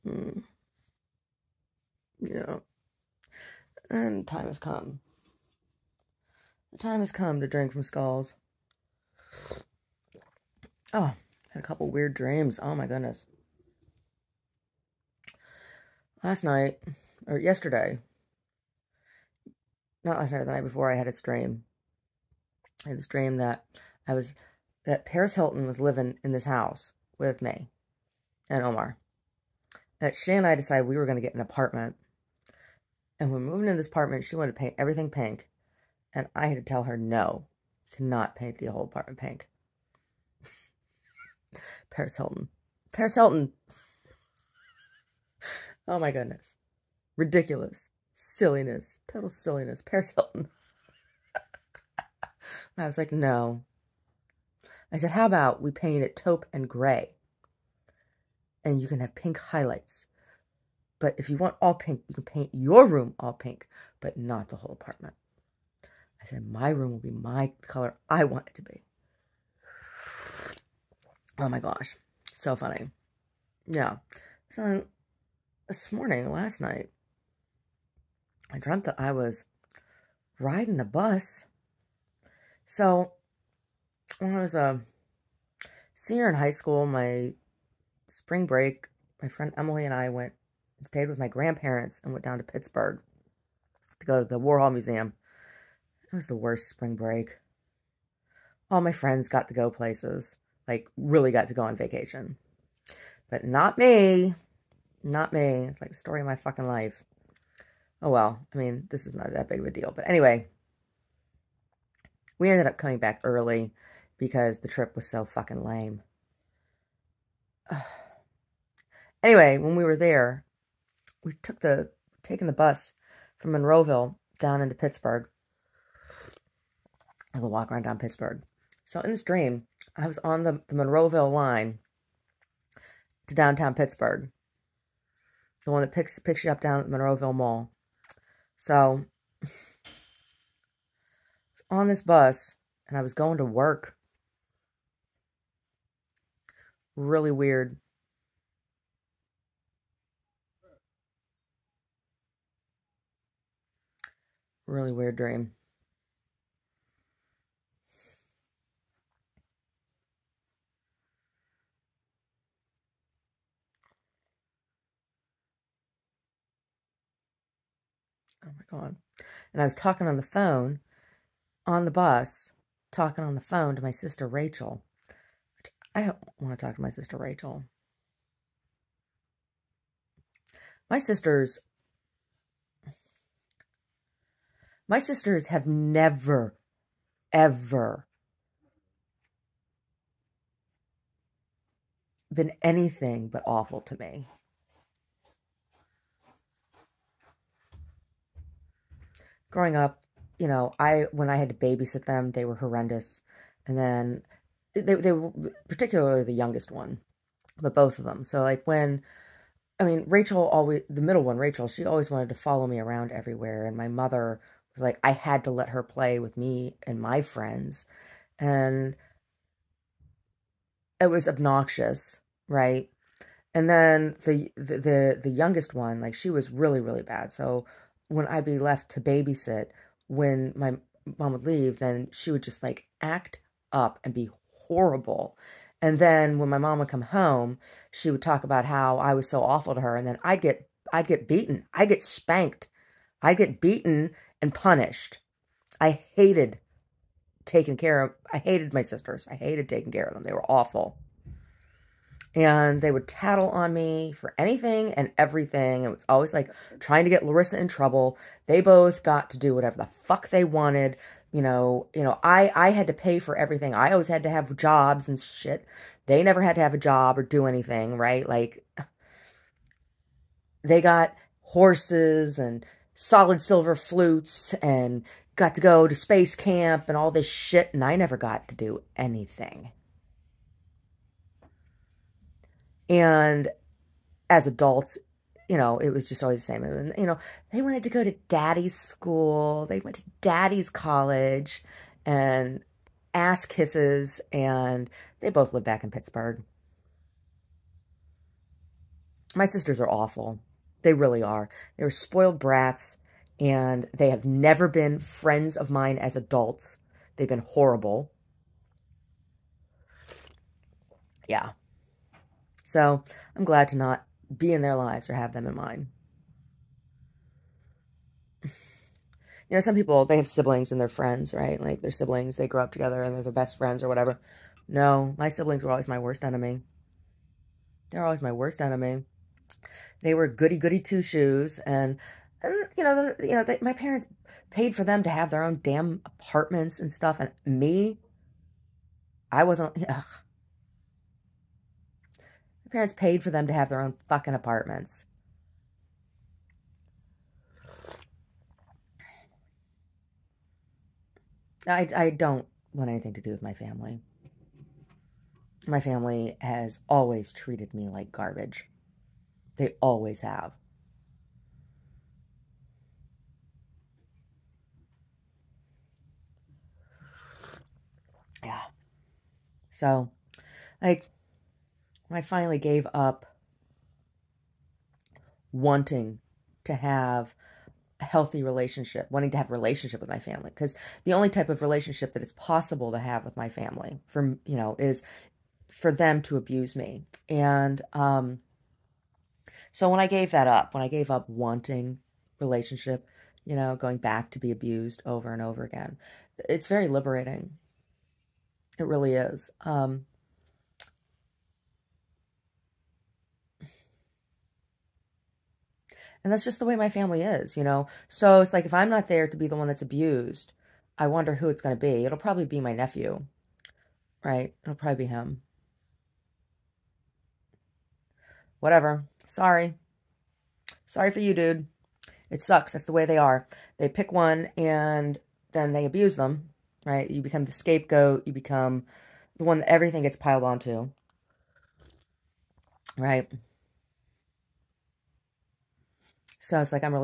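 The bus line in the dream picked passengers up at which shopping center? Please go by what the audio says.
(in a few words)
Monroeville Mall.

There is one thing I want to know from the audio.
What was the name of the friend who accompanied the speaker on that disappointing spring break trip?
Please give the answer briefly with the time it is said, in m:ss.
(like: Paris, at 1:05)
Emily, at 1:29.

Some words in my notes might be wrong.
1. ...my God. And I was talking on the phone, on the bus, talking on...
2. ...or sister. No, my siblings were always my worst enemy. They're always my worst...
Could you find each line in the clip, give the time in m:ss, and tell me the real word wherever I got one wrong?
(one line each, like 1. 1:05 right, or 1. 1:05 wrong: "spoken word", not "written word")
1. 2:48 right
2. 5:23 wrong: "whatever", not "sister".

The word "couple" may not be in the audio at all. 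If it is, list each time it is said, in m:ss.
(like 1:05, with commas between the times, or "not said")
0:11.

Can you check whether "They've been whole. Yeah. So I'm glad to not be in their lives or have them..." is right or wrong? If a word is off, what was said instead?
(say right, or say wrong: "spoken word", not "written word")
wrong: "horrible", not "whole".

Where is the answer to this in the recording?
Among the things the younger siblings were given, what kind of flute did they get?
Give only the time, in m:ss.
4:32.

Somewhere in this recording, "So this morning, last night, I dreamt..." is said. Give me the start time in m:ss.
1:14.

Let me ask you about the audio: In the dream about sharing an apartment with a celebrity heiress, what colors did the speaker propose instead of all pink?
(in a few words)
taupe and gray.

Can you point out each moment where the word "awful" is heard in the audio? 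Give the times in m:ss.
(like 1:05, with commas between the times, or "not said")
3:13, 3:59, 4:10, 4:59.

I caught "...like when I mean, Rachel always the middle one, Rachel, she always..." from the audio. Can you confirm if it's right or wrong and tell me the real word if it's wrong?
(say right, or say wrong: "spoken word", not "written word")
right.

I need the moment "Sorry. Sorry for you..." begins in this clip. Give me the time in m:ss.
6:59.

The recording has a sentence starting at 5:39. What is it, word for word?
Ugh, my parents paid for them to have their own fucking apartments.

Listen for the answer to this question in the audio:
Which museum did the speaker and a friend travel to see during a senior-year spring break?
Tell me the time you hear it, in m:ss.
1:34.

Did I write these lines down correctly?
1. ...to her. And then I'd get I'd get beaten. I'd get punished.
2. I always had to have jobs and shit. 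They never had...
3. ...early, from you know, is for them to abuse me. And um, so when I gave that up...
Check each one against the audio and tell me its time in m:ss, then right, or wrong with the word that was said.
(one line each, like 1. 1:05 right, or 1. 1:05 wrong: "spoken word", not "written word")
1. 3:59 wrong: "spanked", not "punished"
2. 4:23 right
3. 6:23 wrong: "family", not "early".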